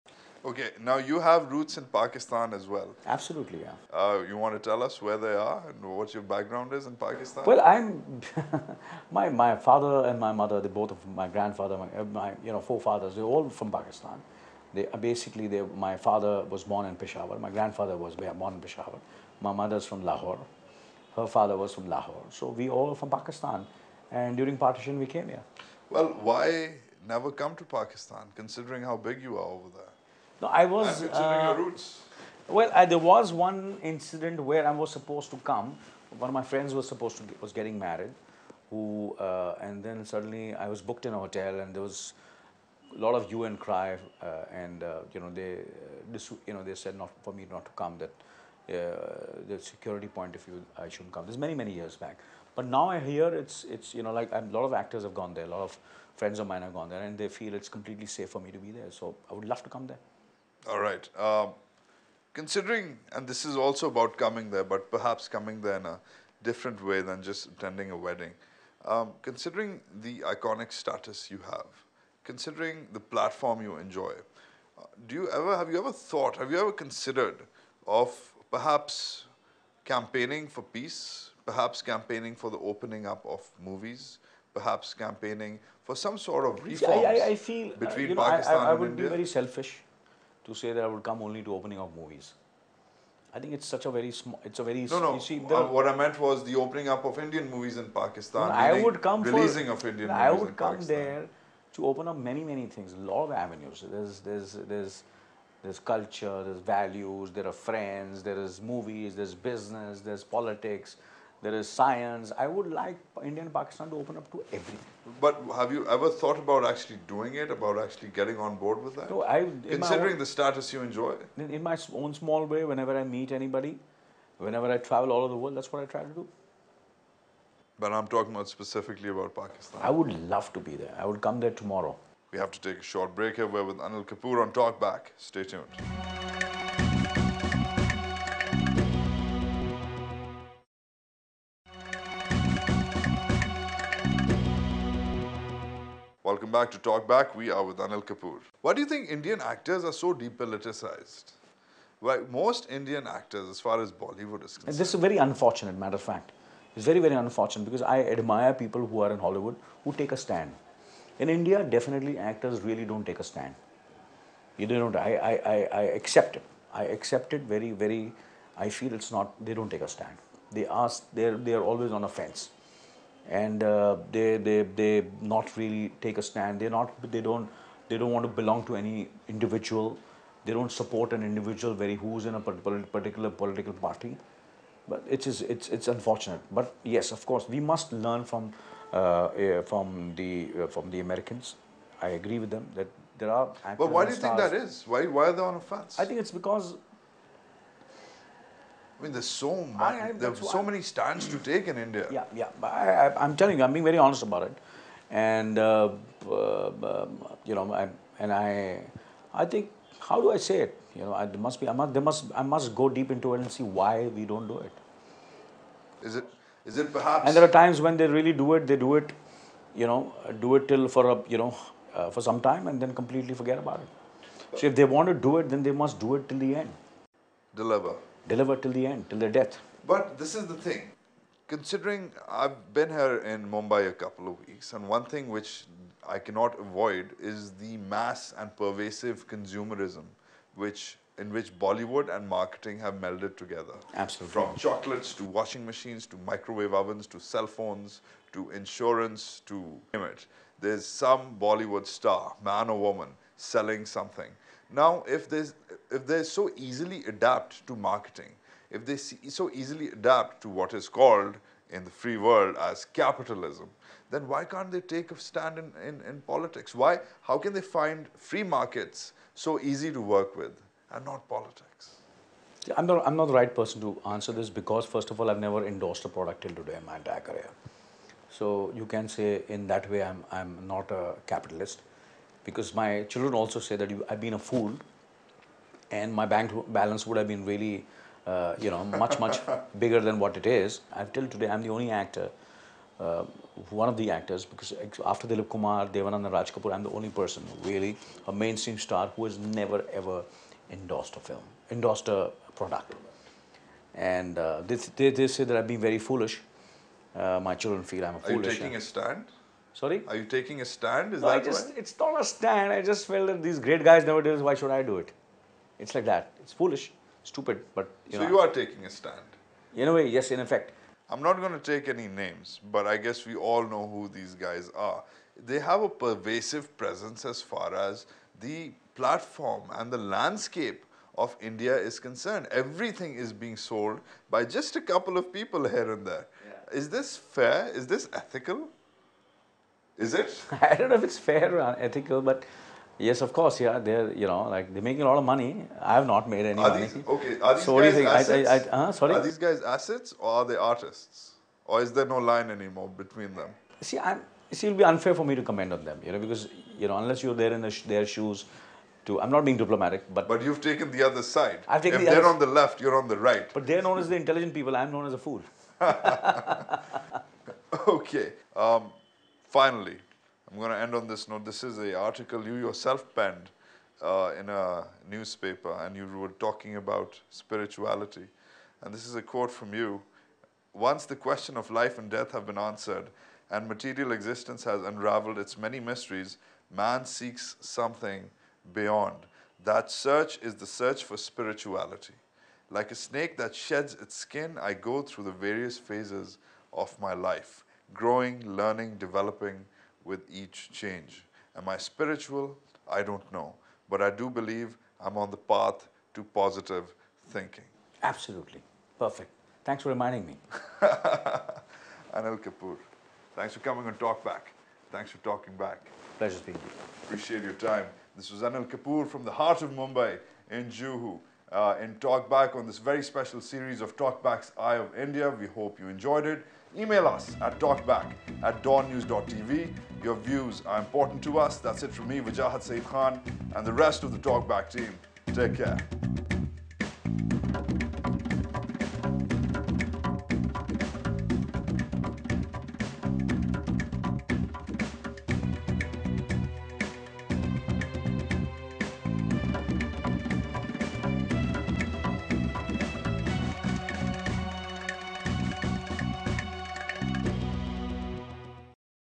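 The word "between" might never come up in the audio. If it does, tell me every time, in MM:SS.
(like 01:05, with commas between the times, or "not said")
01:27, 05:52.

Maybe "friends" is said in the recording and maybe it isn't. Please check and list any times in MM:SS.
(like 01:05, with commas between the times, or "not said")
00:36, 00:56, 01:47.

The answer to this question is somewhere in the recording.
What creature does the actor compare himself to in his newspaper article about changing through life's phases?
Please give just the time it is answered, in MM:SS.
06:32.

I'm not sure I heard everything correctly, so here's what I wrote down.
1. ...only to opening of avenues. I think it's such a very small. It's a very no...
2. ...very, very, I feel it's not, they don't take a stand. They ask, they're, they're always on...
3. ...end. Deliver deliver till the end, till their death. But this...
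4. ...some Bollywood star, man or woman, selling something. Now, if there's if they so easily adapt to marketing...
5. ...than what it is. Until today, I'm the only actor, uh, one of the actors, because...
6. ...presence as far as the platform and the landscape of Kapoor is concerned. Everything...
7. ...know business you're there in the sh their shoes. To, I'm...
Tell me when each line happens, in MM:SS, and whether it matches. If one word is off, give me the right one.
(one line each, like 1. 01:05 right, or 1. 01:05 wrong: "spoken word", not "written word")
1. 01:31 wrong: "movies", not "avenues"
2. 02:47 right
3. 03:46 right
4. 04:10 right
5. 04:49 right
6. 05:26 wrong: "India", not "Kapoor"
7. 05:56 wrong: "unless", not "business".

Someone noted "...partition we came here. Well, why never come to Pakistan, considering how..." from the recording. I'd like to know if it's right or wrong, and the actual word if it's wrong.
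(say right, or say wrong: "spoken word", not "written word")
right.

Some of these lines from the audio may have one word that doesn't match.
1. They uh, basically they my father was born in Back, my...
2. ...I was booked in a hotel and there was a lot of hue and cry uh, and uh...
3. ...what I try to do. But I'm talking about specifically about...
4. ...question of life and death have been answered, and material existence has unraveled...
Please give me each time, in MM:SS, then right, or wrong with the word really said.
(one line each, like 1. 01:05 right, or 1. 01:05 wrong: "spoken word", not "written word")
1. 00:14 wrong: "Peshawar", not "Back"
2. 00:40 right
3. 02:05 right
4. 06:21 right.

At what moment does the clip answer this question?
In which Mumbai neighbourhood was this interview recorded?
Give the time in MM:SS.
07:00.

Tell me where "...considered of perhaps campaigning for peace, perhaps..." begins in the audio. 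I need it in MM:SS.
01:16.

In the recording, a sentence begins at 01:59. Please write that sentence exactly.
No, I, Considering own, the status you enjoy?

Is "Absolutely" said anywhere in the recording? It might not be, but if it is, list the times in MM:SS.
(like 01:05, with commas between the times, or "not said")
00:03, 04:03, 06:48.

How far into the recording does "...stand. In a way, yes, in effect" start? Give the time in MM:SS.
05:18.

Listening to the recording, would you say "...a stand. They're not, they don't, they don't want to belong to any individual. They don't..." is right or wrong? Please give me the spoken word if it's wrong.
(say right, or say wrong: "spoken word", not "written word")
right.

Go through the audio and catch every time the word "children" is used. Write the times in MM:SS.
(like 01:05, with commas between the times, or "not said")
04:43, 05:07.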